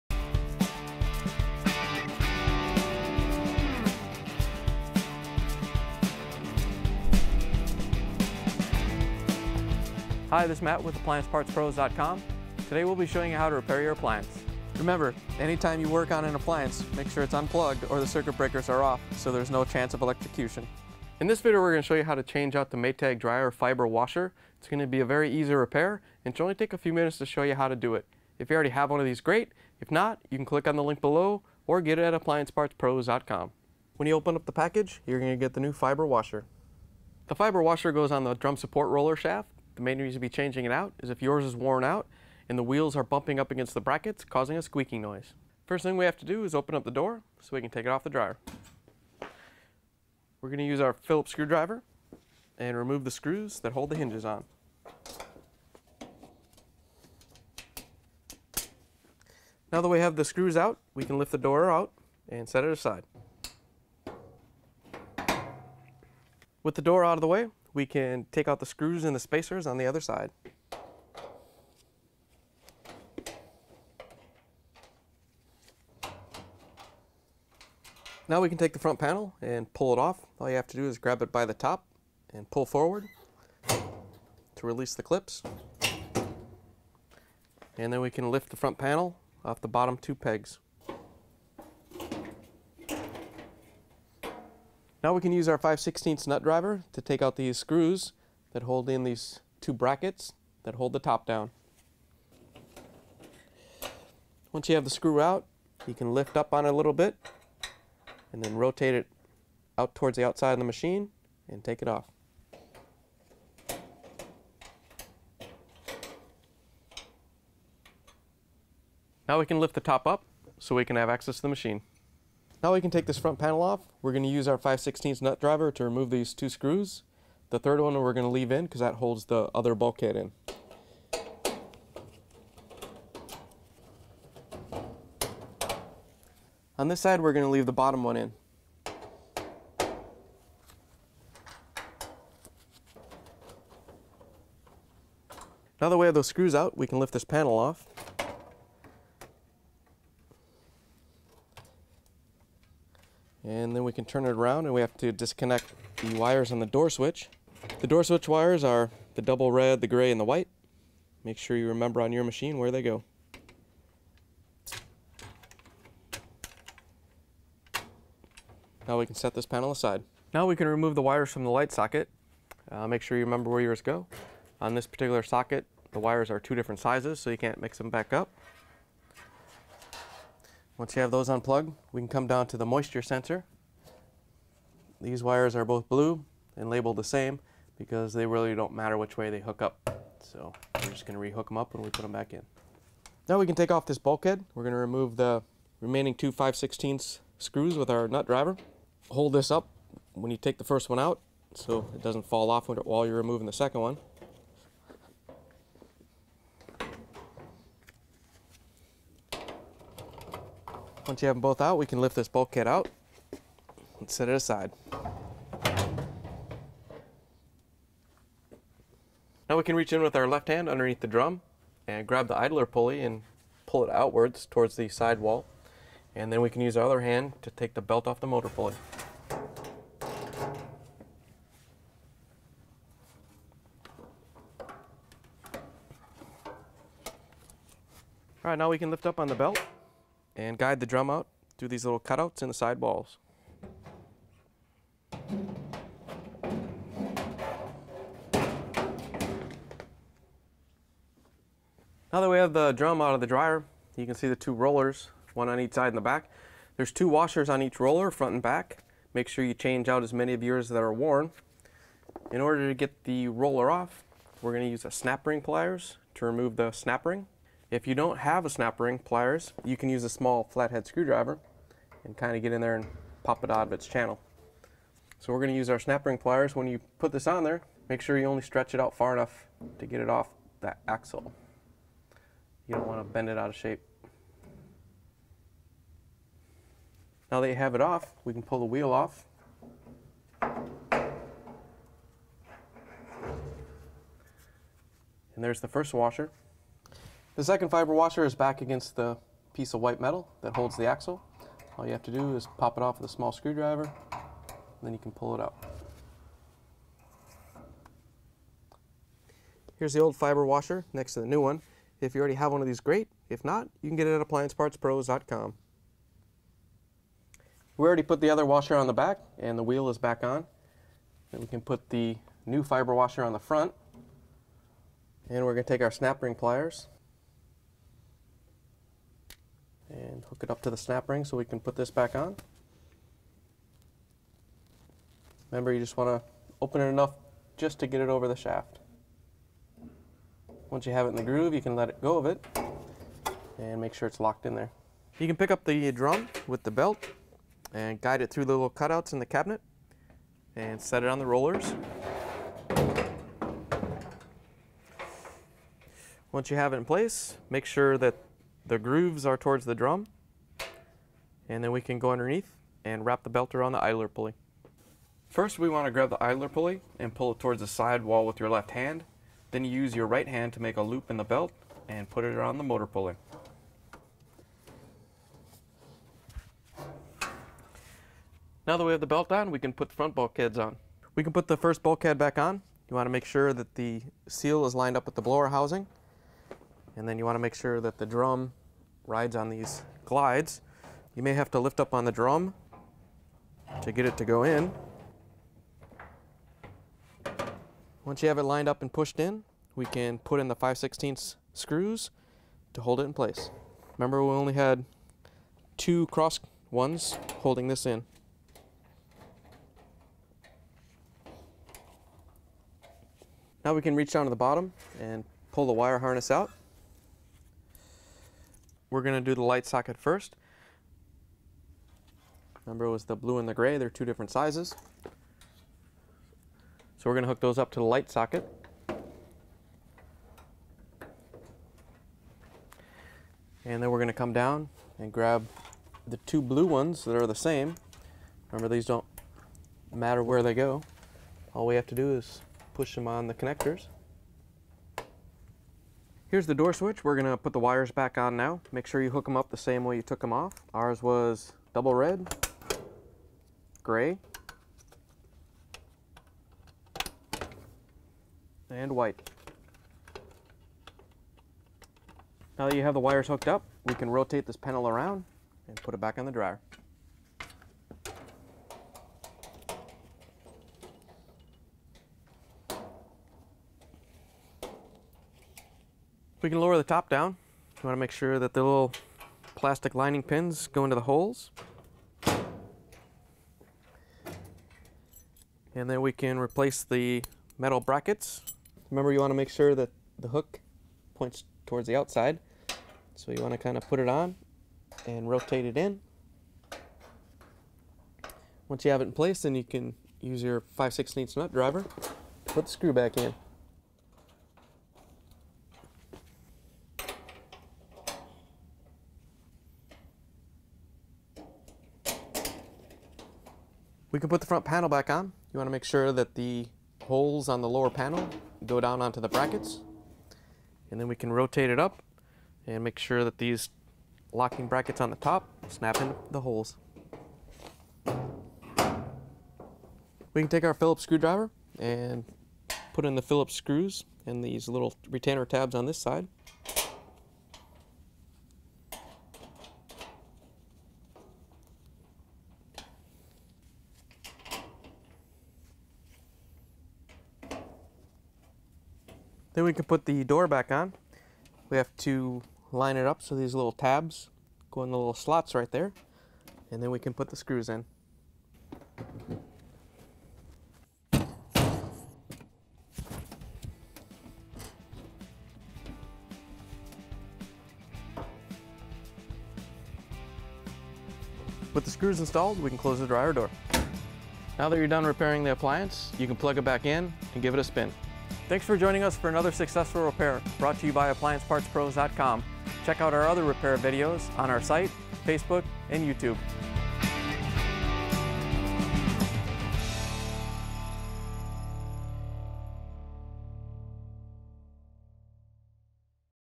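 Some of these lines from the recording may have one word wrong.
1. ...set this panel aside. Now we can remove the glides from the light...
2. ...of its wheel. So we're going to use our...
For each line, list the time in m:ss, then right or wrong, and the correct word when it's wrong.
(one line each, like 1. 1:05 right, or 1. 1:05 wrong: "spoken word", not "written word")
1. 2:49 wrong: "wires", not "glides"
2. 4:33 wrong: "channel", not "wheel".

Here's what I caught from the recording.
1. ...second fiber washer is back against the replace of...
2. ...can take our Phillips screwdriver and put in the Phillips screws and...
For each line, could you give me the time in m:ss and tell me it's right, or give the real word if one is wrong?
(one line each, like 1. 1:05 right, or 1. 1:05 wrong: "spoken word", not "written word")
1. 4:57 wrong: "piece", not "replace"
2. 8:50 right.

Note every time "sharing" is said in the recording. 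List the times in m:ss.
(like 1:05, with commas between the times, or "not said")
not said.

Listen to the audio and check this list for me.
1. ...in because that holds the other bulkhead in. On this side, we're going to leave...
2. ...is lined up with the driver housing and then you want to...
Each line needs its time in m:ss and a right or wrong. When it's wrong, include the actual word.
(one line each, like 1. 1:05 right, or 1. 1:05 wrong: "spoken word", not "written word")
1. 2:08 right
2. 6:24 wrong: "blower", not "driver".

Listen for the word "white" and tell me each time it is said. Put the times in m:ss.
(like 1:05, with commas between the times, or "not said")
2:40, 4:59, 7:38.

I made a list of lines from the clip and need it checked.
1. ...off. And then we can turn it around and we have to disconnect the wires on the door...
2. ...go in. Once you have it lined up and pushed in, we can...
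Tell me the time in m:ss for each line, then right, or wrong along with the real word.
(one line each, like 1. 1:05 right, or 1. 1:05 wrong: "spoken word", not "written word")
1. 2:27 right
2. 6:34 right.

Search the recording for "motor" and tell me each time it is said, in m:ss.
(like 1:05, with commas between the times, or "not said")
3:48, 6:12.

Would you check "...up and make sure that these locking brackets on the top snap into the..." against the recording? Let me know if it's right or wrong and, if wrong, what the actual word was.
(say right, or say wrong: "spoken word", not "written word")
right.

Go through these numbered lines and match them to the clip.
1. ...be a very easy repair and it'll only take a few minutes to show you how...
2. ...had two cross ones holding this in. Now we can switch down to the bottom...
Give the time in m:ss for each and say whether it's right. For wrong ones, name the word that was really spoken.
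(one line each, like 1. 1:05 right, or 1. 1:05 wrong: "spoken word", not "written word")
1. 0:24 right
2. 6:44 wrong: "reach", not "switch".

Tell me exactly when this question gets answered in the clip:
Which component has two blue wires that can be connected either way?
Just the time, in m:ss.
3:02.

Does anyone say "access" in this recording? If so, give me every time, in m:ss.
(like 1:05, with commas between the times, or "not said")
2:01.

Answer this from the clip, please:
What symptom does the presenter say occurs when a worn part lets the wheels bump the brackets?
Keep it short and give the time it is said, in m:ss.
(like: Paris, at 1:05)
squeaking noise, at 0:44.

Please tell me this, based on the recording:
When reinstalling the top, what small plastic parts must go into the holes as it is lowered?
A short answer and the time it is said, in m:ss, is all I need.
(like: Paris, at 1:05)
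lining pins, at 7:59.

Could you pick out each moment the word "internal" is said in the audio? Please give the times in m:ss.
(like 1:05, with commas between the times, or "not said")
not said.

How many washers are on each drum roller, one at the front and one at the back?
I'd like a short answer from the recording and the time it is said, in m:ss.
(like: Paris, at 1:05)
2, at 4:16.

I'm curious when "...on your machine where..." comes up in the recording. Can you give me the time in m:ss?
2:42.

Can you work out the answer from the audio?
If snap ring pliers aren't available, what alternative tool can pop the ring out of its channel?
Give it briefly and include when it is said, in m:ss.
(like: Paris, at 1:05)
small flathead screwdriver, at 4:30.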